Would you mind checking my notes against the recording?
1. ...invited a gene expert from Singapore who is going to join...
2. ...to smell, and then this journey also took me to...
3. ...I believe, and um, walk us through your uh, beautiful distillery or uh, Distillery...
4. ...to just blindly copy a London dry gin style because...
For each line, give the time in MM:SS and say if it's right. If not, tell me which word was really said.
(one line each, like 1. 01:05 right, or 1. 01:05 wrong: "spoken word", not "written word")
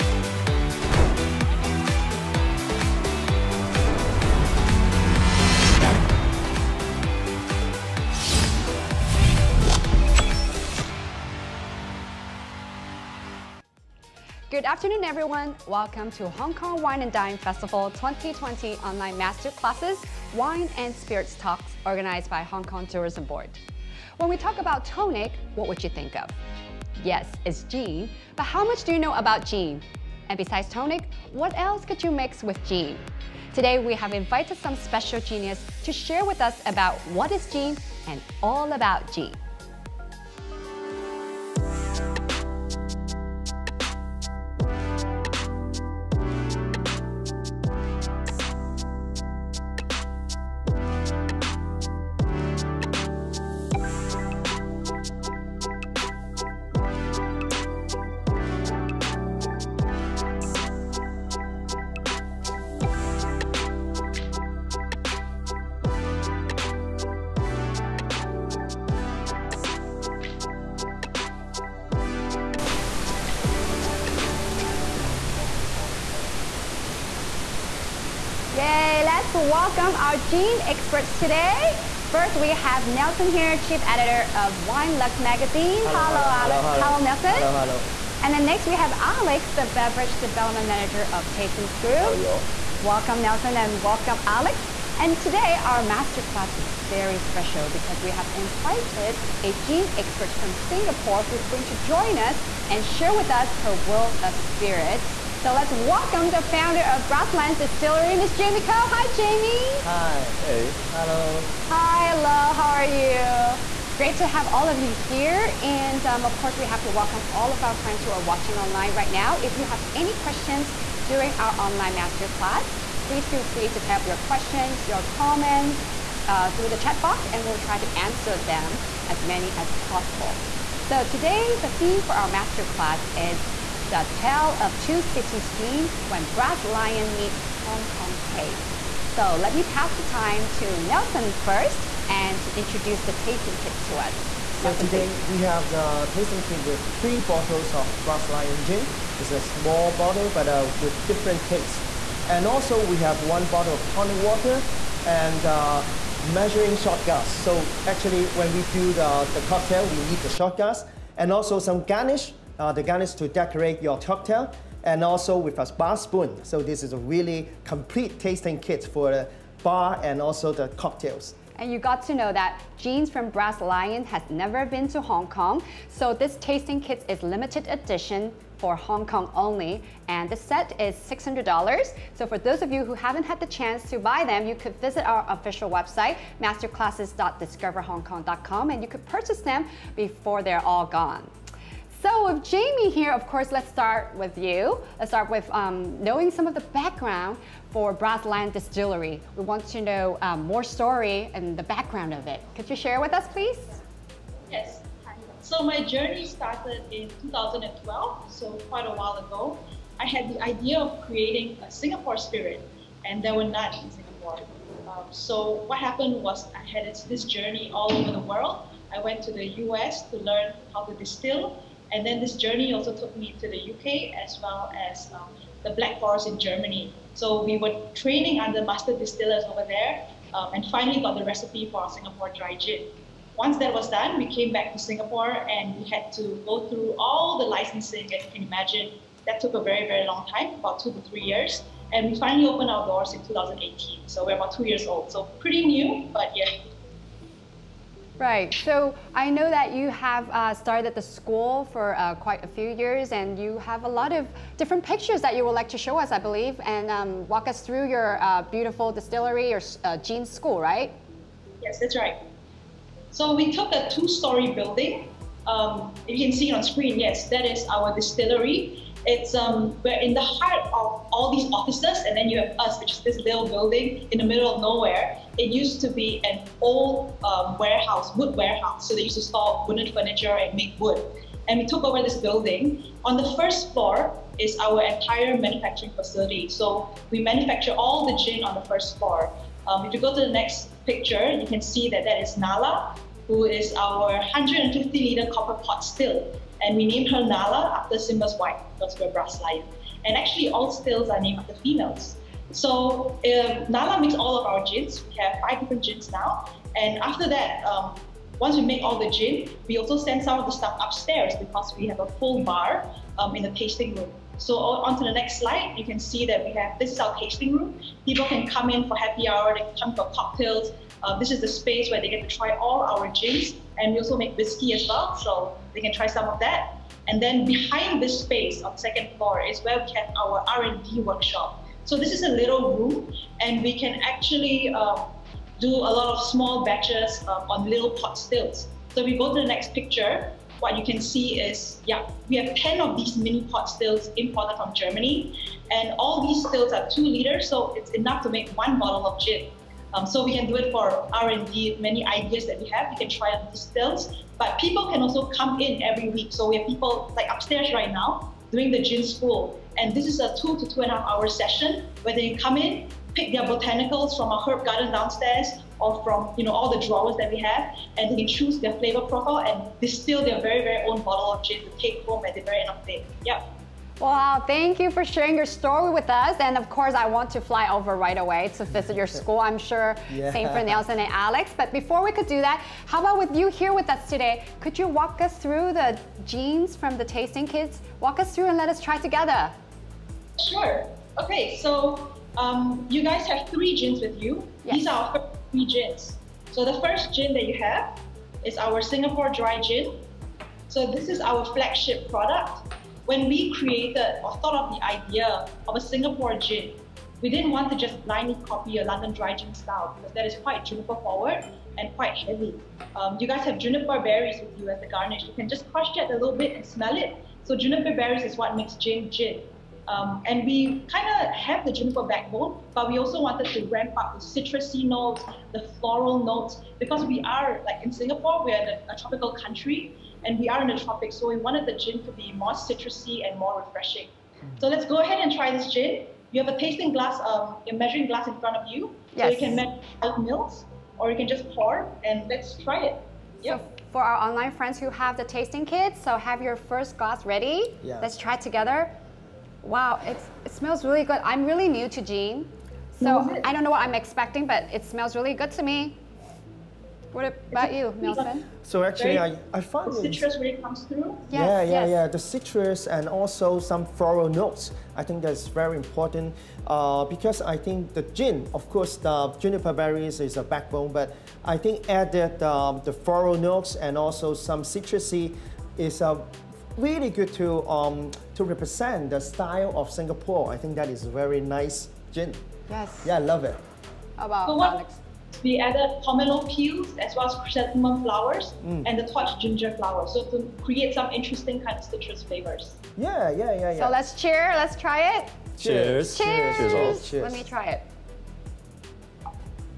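1. 01:38 right
2. 03:40 wrong: "distill", not "smell"
3. 04:16 wrong: "Jean", not "Distillery"
4. 06:47 right.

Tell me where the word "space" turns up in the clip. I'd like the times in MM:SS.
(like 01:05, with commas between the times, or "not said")
05:21, 05:28.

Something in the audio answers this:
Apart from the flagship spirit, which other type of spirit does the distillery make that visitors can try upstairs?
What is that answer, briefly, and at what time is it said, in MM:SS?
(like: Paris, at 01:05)
whiskey, at 05:24.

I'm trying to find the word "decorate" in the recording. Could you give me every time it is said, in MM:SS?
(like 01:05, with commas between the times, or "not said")
02:43.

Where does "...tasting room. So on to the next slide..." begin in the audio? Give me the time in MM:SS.
05:13.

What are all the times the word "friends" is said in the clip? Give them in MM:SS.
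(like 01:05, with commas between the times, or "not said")
01:57, 07:24.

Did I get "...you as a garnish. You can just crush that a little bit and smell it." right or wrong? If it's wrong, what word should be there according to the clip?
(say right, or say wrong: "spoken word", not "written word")
right.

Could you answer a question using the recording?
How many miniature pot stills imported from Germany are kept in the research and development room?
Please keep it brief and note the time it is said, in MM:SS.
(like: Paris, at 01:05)
10, at 05:42.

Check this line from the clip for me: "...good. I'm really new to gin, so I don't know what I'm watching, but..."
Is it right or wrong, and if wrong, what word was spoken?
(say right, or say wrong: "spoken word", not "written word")
wrong: "expecting", not "watching".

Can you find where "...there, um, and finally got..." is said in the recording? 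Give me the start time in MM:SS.
03:49.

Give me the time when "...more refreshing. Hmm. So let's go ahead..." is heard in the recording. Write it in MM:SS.
07:13.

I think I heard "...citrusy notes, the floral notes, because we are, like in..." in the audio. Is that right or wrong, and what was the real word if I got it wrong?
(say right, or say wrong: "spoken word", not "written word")
right.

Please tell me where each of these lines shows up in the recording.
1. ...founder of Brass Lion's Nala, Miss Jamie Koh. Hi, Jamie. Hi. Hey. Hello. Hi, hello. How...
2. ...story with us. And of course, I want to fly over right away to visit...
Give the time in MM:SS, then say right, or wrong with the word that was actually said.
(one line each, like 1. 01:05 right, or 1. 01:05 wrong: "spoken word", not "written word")
1. 01:46 wrong: "Distillery", not "Nala"
2. 06:15 right.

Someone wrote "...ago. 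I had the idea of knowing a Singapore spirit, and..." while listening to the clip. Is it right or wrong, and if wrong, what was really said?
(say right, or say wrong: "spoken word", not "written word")
wrong: "creating", not "knowing".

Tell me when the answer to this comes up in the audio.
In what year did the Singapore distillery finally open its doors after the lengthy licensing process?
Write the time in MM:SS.
04:03.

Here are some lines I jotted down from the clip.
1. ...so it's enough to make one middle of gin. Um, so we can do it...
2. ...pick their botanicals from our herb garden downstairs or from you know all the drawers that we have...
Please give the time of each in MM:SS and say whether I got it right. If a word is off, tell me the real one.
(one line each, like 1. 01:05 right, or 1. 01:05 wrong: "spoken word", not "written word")
1. 05:47 wrong: "bottle", not "middle"
2. 06:03 right.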